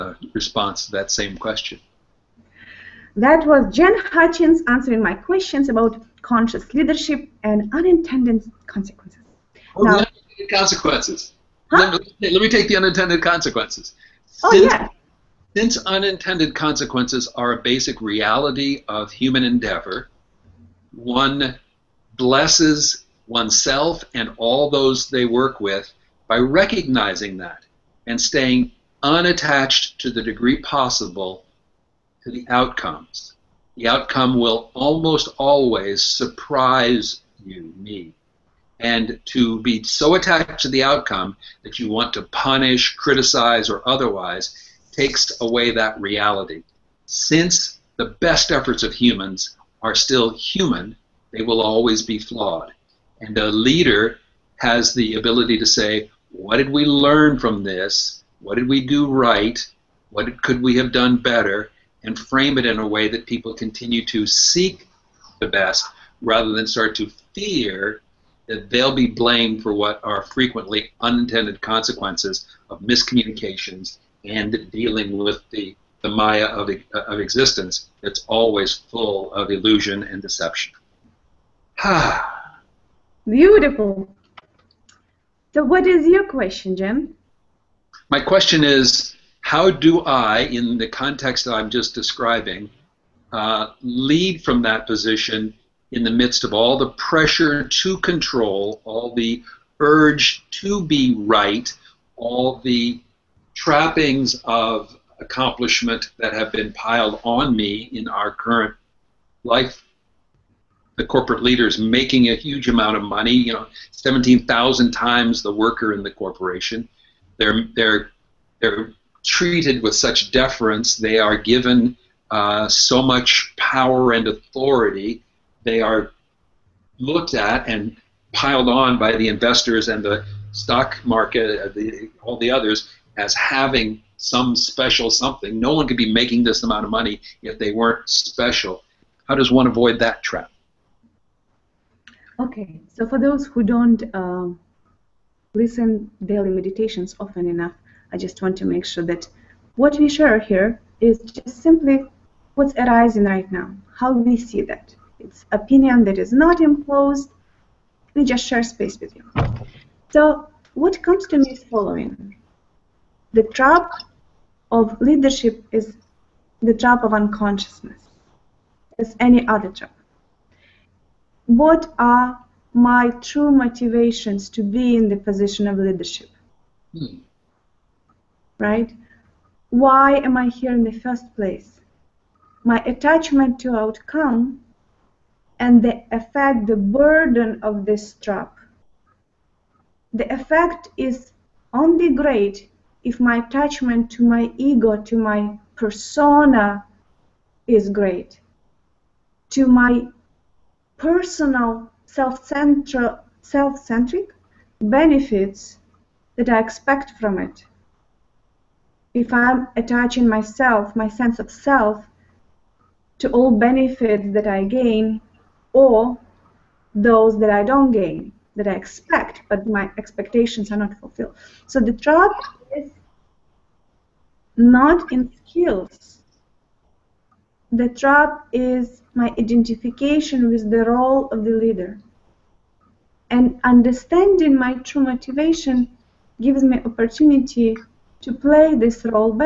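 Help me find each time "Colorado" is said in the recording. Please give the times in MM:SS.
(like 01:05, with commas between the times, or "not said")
not said.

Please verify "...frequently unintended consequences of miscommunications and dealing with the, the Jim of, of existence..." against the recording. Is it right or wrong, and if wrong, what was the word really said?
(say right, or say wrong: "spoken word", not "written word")
wrong: "Maya", not "Jim".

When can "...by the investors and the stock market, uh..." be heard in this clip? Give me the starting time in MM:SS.
02:08.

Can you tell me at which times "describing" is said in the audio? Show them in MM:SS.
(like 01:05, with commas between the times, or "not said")
01:31.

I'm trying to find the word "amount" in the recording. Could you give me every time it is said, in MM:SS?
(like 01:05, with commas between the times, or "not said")
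01:52, 02:16.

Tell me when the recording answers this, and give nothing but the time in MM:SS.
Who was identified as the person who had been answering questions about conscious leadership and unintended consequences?
00:03.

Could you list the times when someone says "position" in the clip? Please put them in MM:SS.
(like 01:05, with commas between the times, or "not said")
01:34, 02:55.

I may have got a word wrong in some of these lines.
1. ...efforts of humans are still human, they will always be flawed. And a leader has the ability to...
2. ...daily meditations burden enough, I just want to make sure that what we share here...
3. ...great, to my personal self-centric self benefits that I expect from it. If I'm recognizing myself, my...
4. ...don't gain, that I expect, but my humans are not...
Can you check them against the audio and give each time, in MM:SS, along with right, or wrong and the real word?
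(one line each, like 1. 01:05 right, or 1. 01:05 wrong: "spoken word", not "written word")
1. 00:48 right
2. 02:26 wrong: "often", not "burden"
3. 03:17 wrong: "attaching", not "recognizing"
4. 03:37 wrong: "expectations", not "humans".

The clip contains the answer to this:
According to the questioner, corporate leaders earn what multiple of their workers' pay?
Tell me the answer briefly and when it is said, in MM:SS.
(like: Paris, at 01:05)
17,000, at 01:53.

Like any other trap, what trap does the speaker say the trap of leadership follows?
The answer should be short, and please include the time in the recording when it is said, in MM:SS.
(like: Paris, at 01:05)
the trap of unconsciousness, at 02:46.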